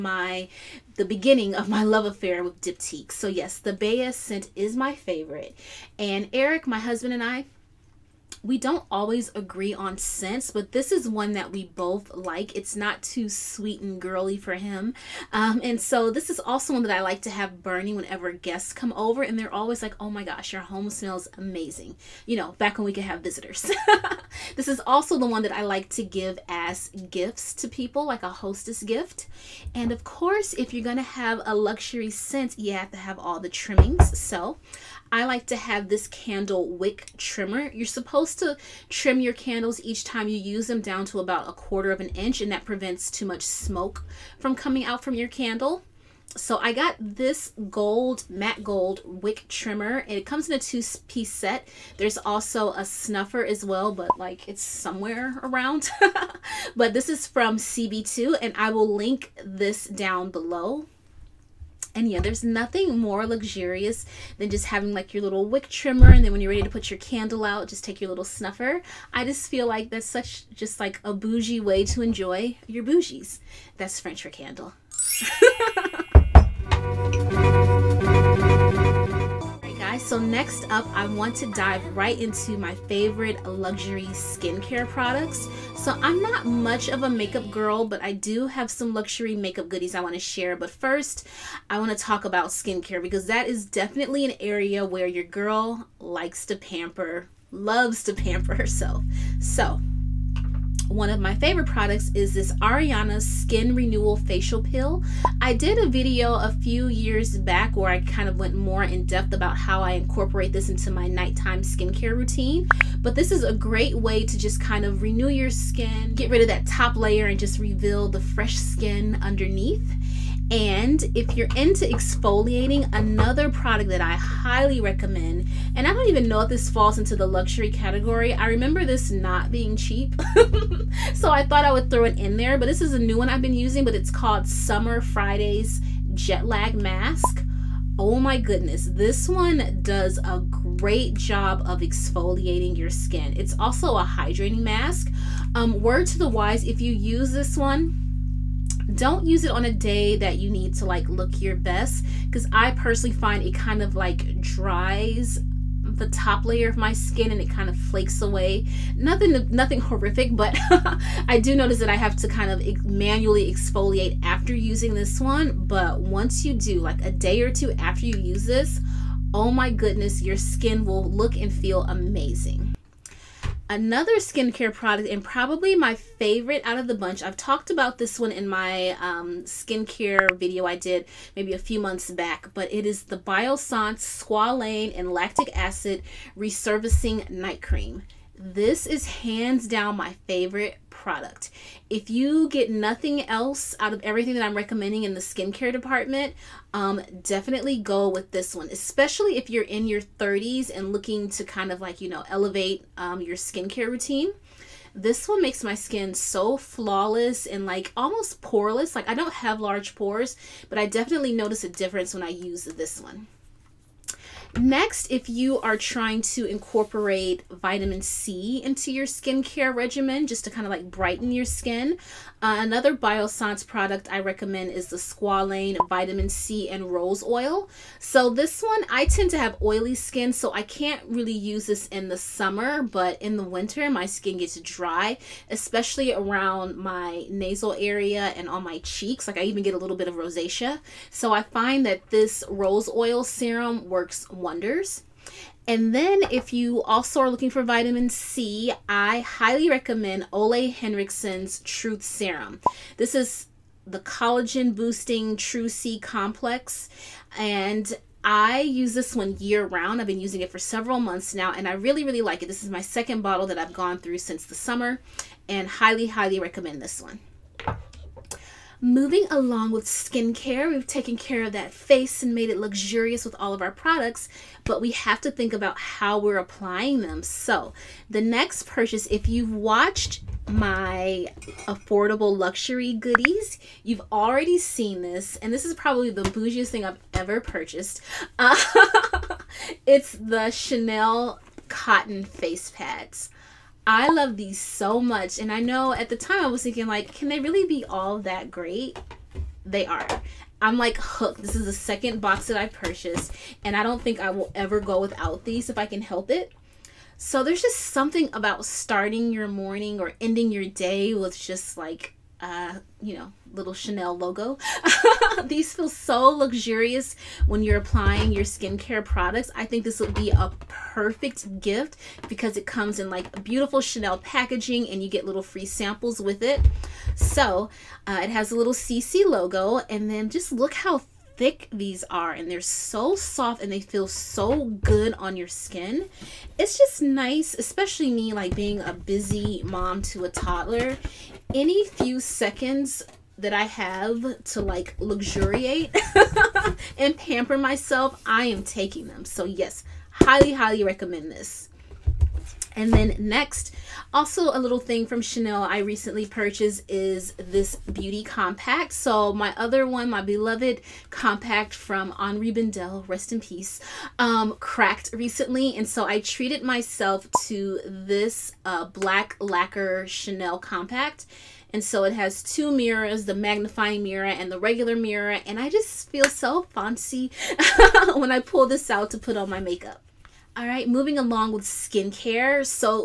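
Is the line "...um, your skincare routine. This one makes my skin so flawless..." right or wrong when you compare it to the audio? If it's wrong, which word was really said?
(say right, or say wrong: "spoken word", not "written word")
right.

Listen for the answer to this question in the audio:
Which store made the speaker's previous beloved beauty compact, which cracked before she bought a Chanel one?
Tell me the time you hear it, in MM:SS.
06:02.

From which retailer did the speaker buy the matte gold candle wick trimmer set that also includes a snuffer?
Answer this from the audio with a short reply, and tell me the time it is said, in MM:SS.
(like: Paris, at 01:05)
CB2, at 00:57.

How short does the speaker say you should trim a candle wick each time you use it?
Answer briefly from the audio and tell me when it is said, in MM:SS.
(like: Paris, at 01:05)
a quarter of an inch, at 00:41.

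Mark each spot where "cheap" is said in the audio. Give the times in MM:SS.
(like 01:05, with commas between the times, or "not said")
02:09.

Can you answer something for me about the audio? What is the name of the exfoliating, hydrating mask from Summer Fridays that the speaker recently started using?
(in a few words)
Jet Lag Mask.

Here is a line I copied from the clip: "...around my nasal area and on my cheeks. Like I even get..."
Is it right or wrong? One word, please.
right.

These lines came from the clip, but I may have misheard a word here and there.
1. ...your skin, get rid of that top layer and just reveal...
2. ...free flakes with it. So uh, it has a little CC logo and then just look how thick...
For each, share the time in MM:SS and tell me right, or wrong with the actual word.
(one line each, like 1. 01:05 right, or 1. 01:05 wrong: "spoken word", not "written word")
1. 01:55 right
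2. 05:25 wrong: "samples", not "flakes".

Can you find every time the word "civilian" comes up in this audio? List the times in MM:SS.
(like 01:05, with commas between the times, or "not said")
not said.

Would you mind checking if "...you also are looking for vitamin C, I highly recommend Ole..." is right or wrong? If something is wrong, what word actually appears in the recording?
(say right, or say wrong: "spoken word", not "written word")
right.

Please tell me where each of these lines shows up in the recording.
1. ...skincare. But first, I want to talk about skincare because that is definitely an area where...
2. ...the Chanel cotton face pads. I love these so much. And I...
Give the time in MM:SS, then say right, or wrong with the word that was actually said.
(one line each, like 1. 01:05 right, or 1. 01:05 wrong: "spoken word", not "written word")
1. 01:30 wrong: "share", not "skincare"
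2. 04:50 right.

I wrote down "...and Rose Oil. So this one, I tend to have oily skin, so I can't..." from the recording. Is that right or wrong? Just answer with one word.
right.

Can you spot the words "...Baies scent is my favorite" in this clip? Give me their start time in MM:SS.
00:03.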